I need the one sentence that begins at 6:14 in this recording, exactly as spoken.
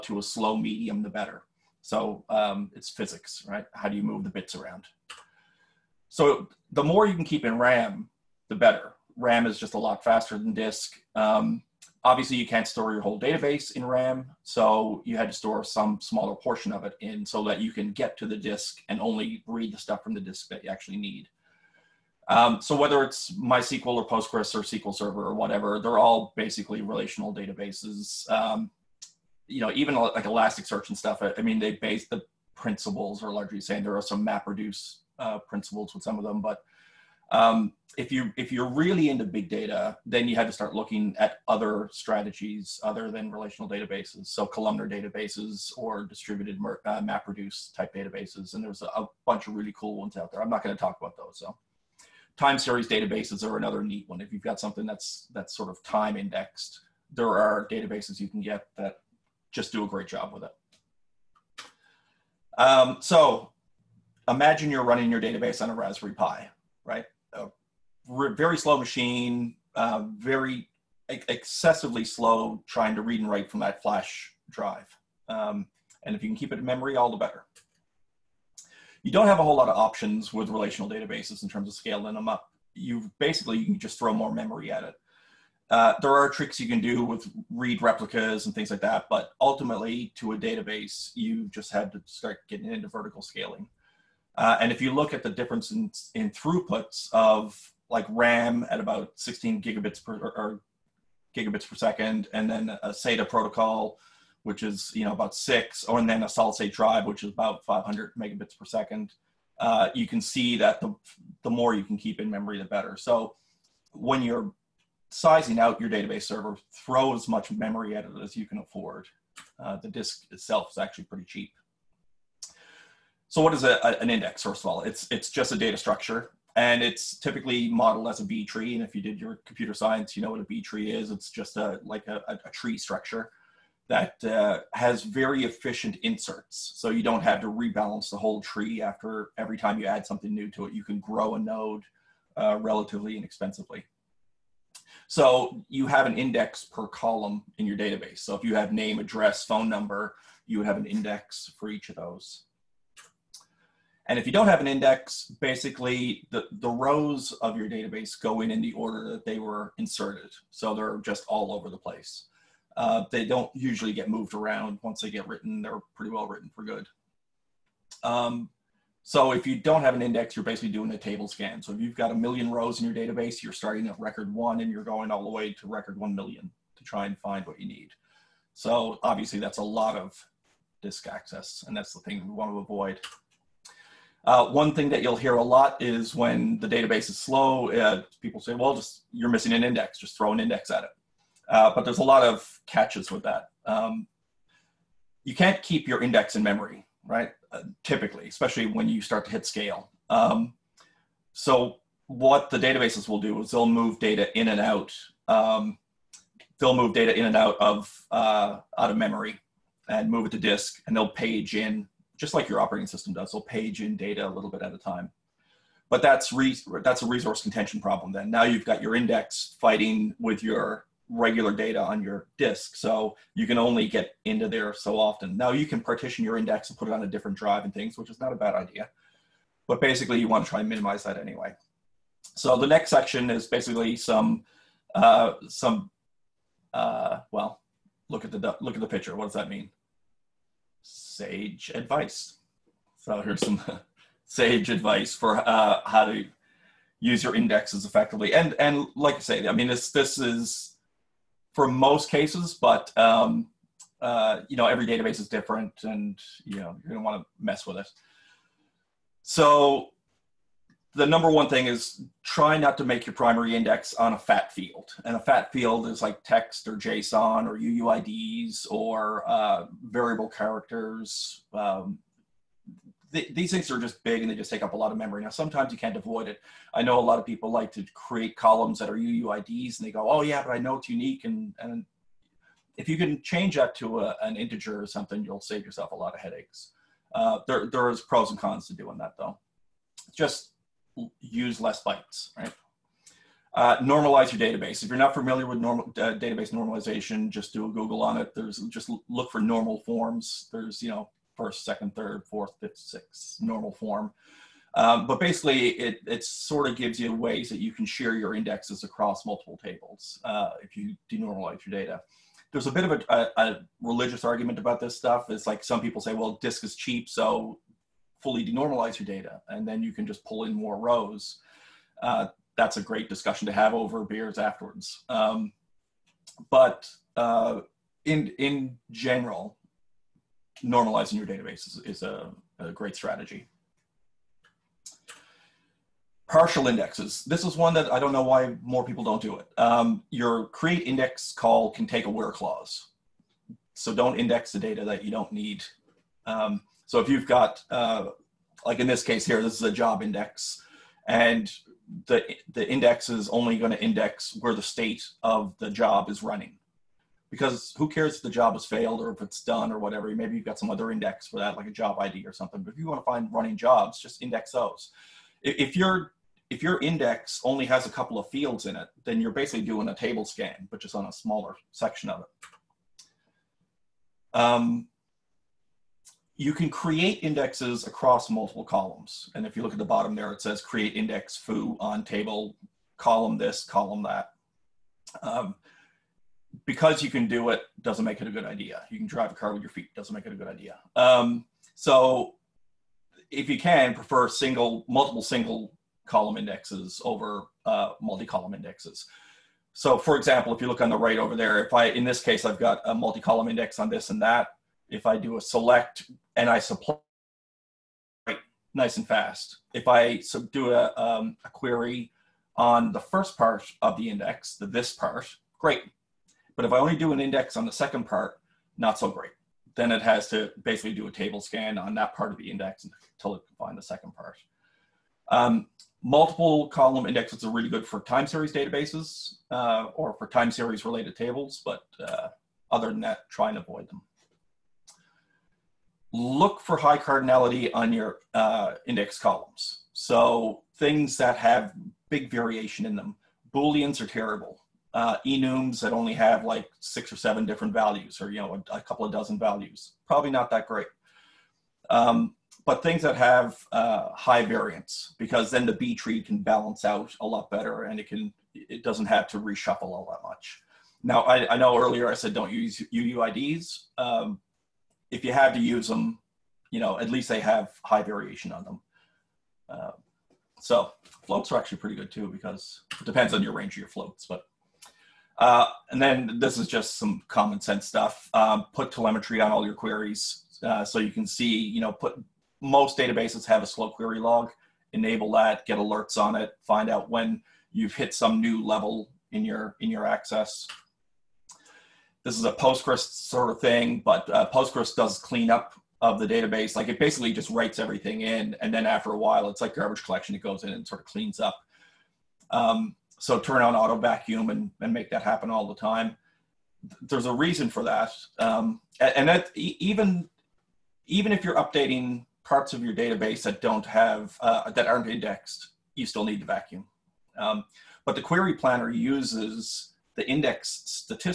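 Um, you can create indexes across multiple columns.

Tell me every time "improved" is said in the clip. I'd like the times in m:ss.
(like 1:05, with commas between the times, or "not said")
not said.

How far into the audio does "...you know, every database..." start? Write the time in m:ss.
4:14.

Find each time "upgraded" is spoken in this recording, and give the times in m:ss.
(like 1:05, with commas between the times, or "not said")
not said.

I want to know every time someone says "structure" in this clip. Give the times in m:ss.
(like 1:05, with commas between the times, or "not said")
2:05, 2:12.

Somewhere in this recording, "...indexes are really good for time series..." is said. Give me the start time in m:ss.
7:07.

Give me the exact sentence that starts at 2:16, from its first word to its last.
So you don't have to rebalance the whole tree after every time you add something new to it.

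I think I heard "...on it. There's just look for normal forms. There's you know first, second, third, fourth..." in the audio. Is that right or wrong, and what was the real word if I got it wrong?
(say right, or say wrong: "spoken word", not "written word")
right.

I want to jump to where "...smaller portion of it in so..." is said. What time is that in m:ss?
0:16.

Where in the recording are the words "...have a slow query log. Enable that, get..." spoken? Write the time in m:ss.
8:03.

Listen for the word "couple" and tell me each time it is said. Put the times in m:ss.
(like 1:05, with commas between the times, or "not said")
6:07, 7:28.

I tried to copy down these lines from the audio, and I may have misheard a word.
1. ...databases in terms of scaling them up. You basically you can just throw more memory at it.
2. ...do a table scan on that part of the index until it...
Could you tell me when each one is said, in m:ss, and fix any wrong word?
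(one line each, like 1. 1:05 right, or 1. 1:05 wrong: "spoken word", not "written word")
1. 1:20 right
2. 7:00 right.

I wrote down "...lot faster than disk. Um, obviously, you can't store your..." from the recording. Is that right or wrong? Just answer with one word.
right.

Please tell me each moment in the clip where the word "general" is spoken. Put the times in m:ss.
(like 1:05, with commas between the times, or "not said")
5:28.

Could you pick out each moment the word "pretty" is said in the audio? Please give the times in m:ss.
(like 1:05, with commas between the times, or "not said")
2:01, 2:45, 7:51.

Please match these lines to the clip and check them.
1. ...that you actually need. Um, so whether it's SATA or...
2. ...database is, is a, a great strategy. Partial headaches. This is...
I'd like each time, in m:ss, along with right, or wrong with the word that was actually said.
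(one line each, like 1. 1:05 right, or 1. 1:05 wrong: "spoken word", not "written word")
1. 0:20 wrong: "MySQL", not "SATA"
2. 5:31 wrong: "indexes", not "headaches".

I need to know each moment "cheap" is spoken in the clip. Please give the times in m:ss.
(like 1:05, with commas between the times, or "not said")
2:01, 5:16.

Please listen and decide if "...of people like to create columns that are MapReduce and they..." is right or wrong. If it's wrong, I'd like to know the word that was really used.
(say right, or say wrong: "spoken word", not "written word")
wrong: "UUIDs", not "MapReduce".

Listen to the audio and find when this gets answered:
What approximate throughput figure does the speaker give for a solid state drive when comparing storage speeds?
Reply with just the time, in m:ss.
1:47.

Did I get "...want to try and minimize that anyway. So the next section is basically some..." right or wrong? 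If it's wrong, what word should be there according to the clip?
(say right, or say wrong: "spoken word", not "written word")
right.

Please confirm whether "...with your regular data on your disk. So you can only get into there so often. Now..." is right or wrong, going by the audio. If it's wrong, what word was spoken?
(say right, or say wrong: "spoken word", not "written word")
right.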